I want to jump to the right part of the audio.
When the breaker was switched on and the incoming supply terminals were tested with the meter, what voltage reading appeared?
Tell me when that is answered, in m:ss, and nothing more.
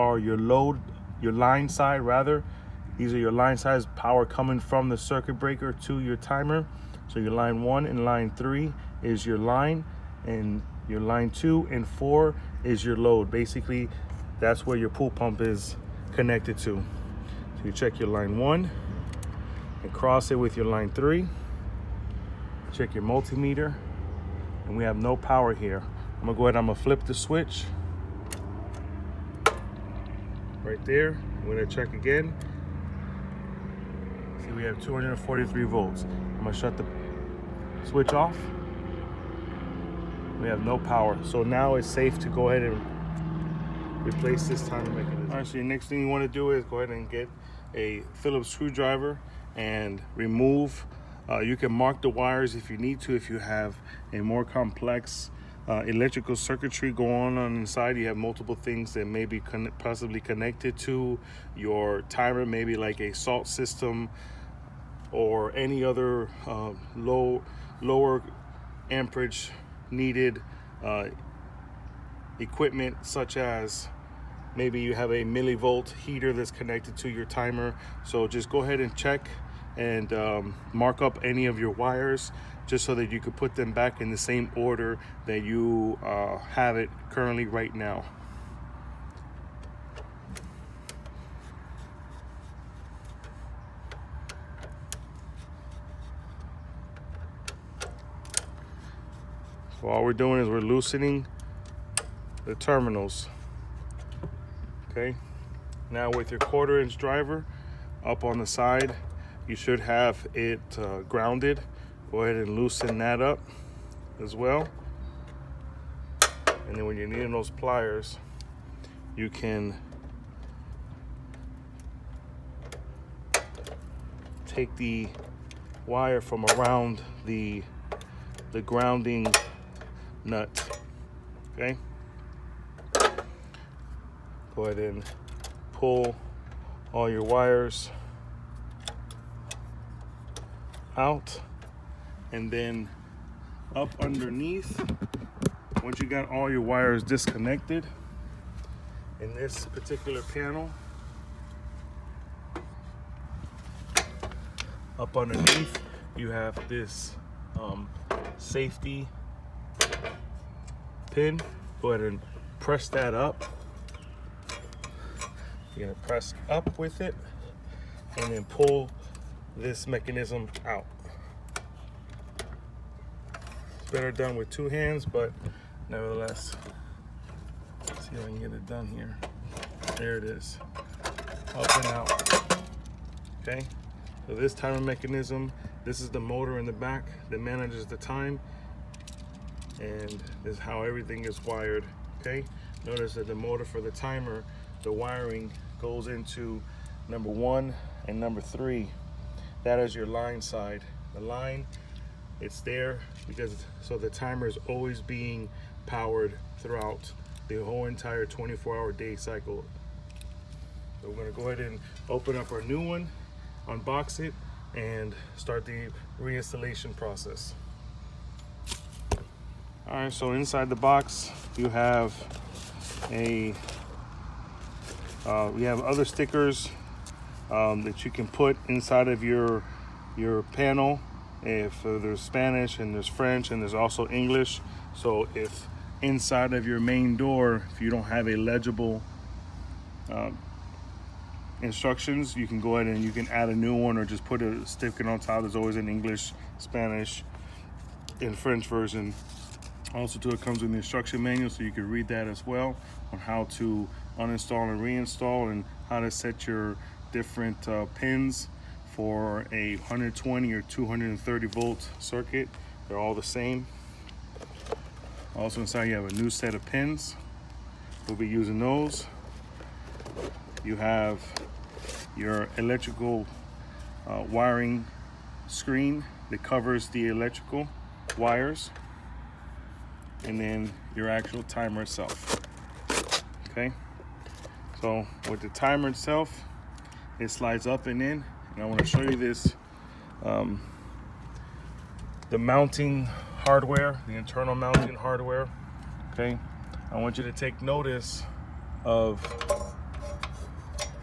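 0:34.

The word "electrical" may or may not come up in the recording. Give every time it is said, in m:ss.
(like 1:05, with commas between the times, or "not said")
0:55, 4:32, 4:37.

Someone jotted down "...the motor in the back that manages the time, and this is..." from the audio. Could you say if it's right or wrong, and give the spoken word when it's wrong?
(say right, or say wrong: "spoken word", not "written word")
right.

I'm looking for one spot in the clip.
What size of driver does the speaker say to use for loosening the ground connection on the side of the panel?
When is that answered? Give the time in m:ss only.
1:46.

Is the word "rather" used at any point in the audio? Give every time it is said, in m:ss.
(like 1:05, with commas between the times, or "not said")
0:02.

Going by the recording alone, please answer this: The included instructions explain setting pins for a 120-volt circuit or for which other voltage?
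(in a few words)
230 volt.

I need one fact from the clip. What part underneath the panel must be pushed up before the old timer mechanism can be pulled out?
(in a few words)
safety pin.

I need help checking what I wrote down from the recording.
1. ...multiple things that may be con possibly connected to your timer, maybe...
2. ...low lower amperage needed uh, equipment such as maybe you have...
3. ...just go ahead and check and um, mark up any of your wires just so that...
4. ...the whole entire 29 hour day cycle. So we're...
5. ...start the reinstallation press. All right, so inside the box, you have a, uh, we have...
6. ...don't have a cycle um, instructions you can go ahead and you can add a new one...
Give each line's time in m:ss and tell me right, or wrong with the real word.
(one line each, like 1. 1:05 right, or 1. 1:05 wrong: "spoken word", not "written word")
1. 0:58 right
2. 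1:06 right
3. 1:18 right
4. 3:27 wrong: "24", not "29"
5. 3:35 wrong: "process", not "press"
6. 3:57 wrong: "legible", not "cycle".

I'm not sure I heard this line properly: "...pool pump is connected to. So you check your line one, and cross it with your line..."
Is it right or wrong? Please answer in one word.
right.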